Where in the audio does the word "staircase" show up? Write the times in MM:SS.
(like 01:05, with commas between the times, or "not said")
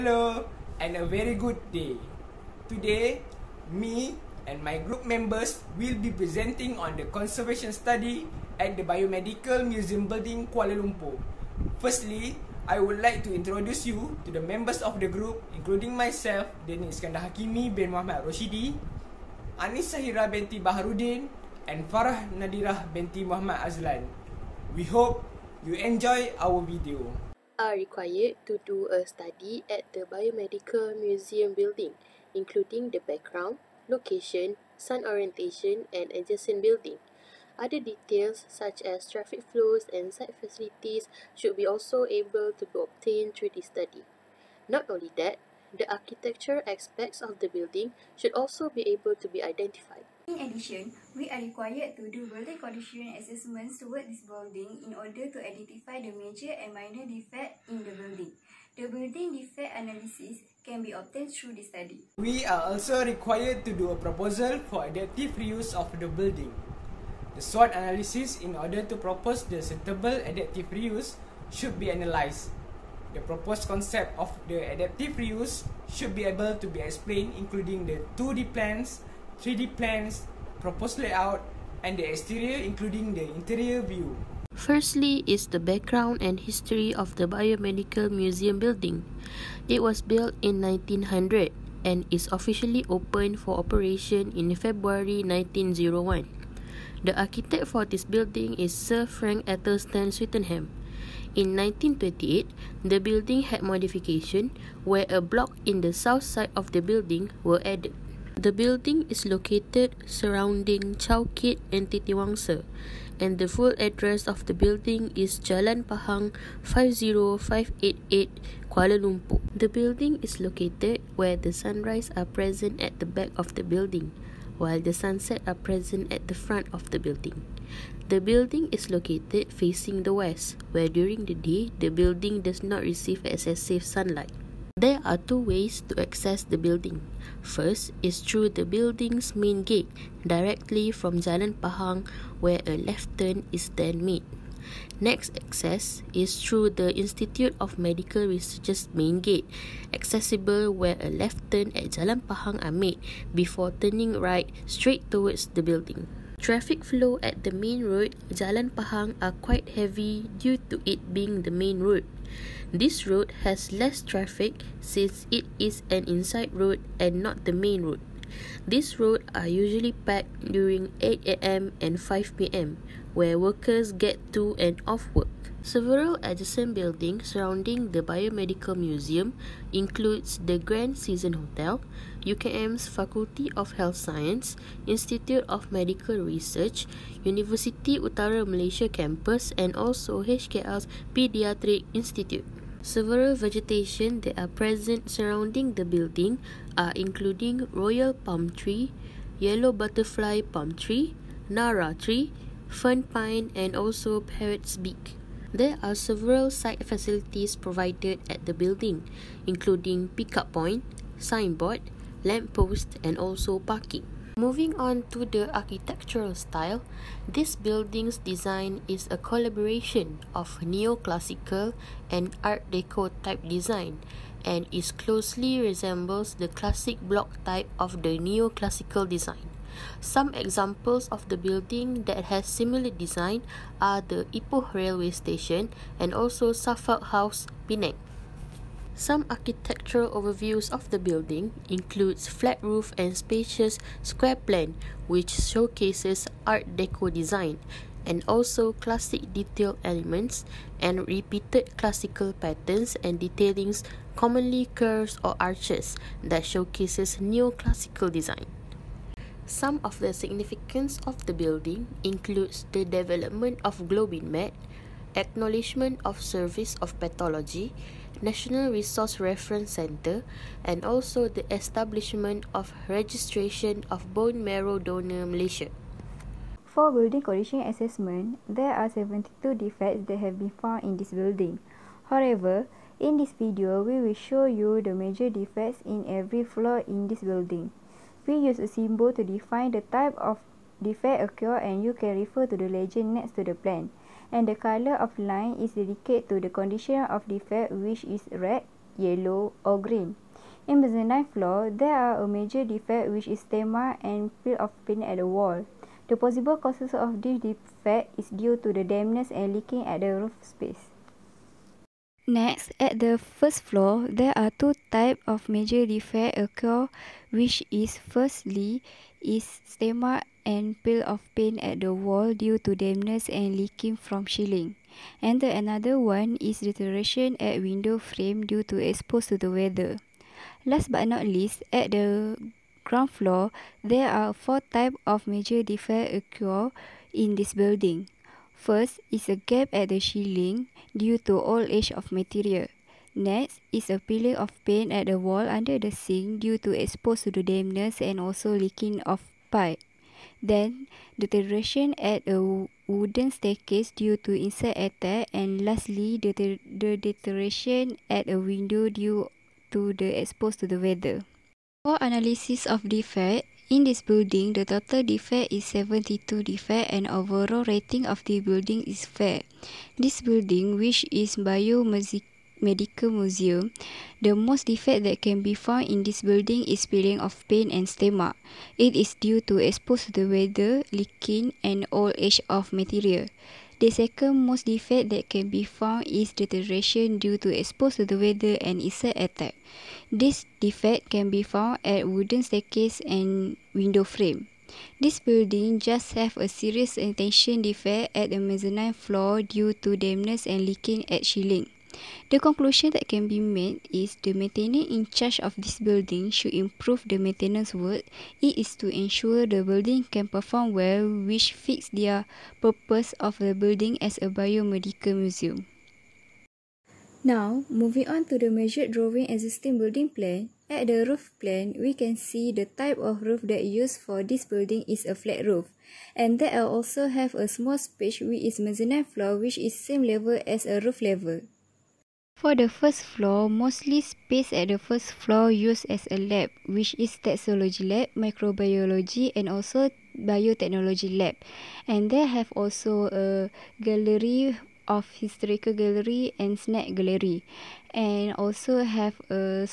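05:53, 06:32.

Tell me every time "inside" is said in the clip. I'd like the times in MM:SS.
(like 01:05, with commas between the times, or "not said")
02:46.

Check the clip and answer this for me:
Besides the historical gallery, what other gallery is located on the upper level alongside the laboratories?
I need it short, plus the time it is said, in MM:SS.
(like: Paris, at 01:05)
Snack gallery, at 07:26.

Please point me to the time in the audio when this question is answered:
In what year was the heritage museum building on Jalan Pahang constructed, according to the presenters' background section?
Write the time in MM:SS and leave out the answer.
01:30.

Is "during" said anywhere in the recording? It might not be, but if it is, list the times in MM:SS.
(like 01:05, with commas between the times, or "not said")
02:10, 02:50.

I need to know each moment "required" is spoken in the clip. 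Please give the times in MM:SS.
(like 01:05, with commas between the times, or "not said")
00:27, 00:51, 01:03.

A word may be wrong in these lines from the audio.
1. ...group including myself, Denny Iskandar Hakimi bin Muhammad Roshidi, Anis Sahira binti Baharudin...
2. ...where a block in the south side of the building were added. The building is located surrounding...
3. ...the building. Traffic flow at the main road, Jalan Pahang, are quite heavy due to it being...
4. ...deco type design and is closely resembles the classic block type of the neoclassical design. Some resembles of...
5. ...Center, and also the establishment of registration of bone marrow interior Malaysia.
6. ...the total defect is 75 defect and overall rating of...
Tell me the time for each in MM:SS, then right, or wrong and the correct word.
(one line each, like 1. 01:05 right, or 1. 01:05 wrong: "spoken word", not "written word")
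1. 00:15 right
2. 01:44 right
3. 02:35 right
4. 03:42 wrong: "examples", not "resembles"
5. 04:29 wrong: "donor", not "interior"
6. 06:04 wrong: "72", not "75".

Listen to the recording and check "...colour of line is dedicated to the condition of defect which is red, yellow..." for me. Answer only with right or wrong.
right.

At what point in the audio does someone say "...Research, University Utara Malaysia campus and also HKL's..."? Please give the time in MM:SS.
03:06.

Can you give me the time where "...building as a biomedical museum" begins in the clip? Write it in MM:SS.
06:53.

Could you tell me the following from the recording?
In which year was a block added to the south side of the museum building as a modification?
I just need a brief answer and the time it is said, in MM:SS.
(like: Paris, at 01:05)
1928, at 01:41.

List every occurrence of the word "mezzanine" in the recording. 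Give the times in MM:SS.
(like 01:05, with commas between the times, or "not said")
06:38, 07:08.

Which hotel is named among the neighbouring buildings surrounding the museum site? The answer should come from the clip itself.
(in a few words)
Grand Season Hotel.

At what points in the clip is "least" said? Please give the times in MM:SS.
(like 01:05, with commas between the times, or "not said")
05:31.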